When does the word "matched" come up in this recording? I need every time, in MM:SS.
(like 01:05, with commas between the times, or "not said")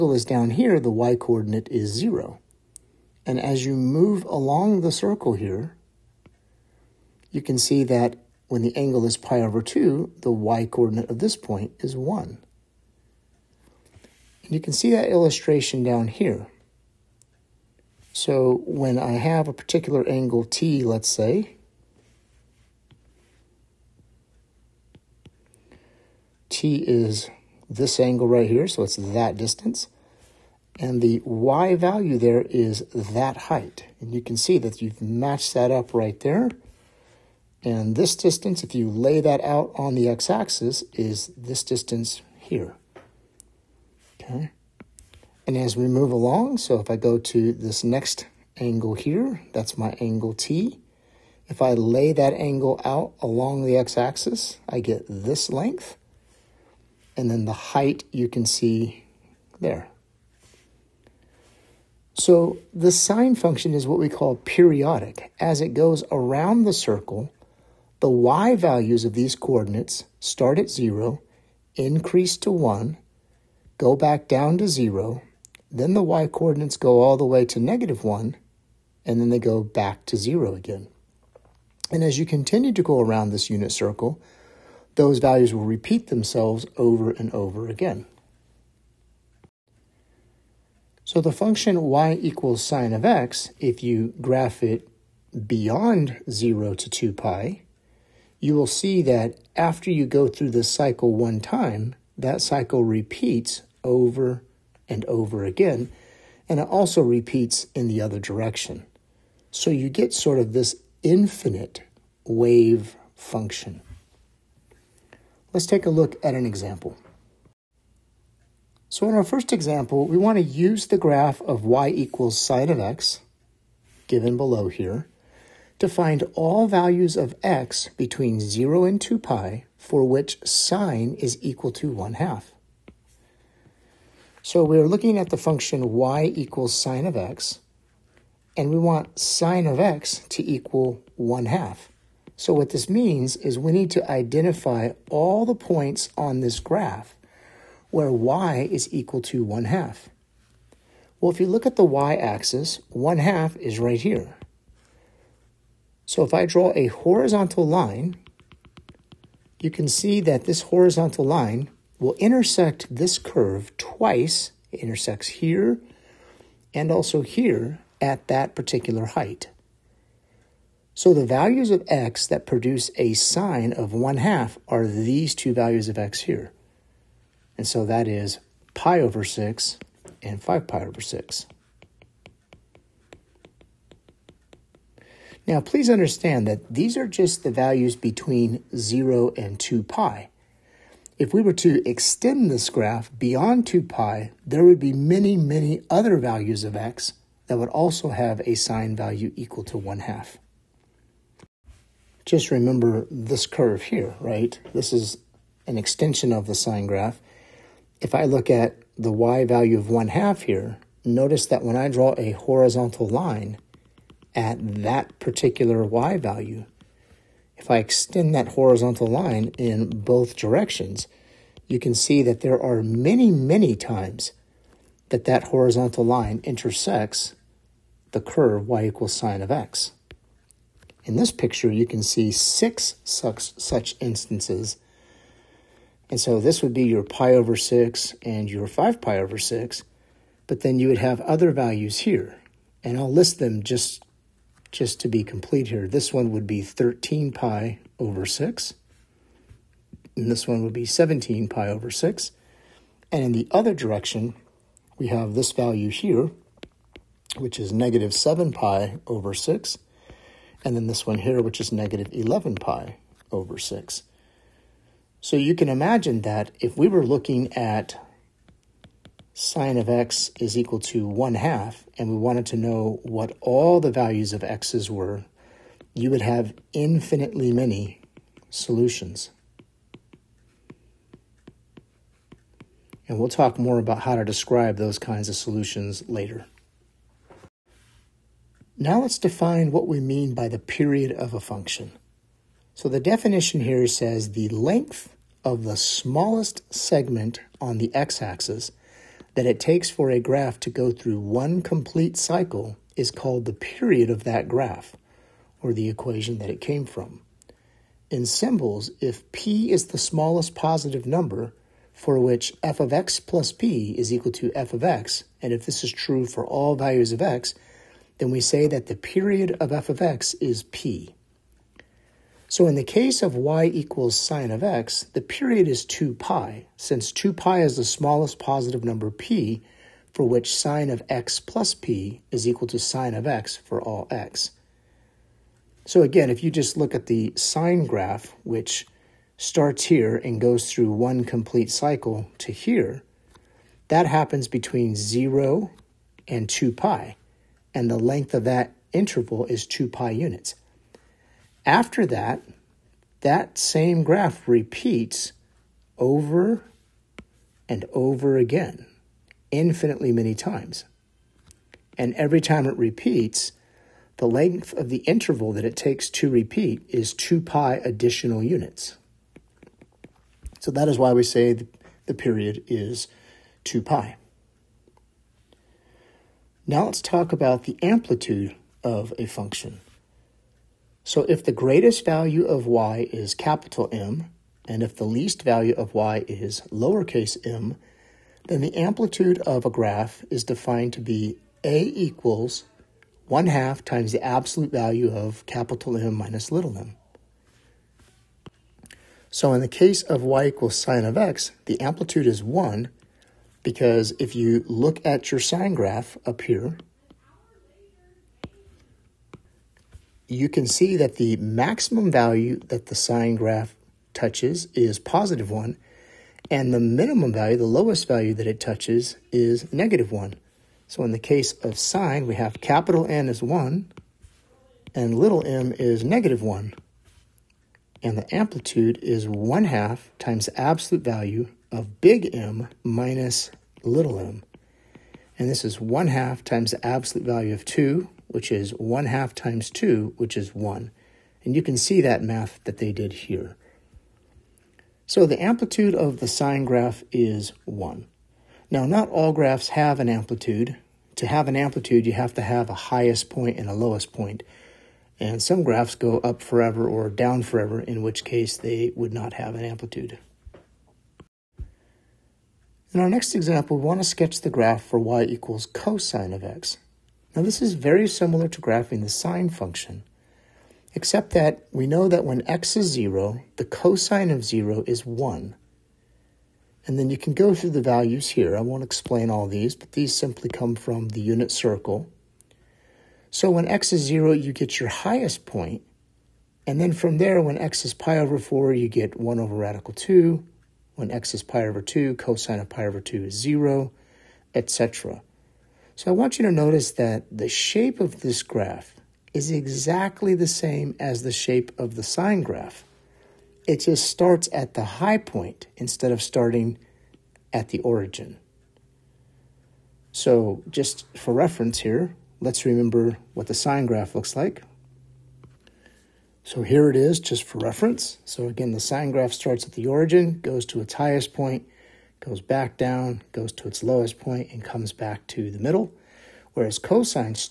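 00:35.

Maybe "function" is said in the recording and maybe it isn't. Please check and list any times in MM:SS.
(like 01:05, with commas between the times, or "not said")
01:03, 01:31, 01:53, 02:15, 04:51, 06:19, 07:49.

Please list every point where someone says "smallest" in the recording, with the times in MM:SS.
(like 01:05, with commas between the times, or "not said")
04:55, 05:09, 05:27.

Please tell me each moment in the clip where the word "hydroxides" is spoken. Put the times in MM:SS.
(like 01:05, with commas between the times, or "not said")
not said.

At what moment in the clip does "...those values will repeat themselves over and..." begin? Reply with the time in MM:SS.
01:24.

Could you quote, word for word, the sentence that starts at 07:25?
So the amplitude of the sine graph is 1.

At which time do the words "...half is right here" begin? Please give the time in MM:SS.
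02:33.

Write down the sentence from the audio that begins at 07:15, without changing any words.
And this is 1 half times the absolute value of 2 which is 1 half times 2, which is 1.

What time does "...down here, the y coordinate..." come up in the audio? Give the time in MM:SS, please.
00:00.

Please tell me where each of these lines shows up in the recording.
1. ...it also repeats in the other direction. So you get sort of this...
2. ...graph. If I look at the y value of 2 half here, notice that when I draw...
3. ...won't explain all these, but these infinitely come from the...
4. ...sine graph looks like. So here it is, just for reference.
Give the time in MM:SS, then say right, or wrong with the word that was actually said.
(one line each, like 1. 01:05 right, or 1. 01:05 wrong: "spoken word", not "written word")
1. 01:46 right
2. 03:26 wrong: "1", not "2"
3. 07:58 wrong: "simply", not "infinitely"
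4. 08:33 right.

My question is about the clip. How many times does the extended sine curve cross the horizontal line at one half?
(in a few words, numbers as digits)
6.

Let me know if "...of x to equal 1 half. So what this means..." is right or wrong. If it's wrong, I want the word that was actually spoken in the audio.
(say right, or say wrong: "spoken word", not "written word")
right.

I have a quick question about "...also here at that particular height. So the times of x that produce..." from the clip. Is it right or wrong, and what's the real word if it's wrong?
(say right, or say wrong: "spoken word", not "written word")
wrong: "values", not "times".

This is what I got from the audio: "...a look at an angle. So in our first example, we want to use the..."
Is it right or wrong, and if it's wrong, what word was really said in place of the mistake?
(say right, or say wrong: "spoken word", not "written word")
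wrong: "example", not "angle".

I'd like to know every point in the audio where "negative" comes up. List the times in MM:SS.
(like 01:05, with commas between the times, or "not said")
01:17, 04:17, 04:21, 06:59, 07:06.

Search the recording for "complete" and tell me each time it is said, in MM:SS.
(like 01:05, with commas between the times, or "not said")
04:05, 05:01, 05:41.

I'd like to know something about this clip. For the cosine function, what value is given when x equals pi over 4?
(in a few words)
1/√2.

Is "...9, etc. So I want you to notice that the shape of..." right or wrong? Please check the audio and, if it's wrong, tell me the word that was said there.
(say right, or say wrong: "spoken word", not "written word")
wrong: "0", not "9".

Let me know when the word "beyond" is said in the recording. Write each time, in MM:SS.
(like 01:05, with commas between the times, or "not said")
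01:35, 03:13.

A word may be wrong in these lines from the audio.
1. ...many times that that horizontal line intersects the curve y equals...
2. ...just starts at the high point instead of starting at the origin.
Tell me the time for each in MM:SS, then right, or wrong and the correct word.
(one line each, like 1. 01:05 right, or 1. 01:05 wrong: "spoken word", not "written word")
1. 03:43 right
2. 08:23 right.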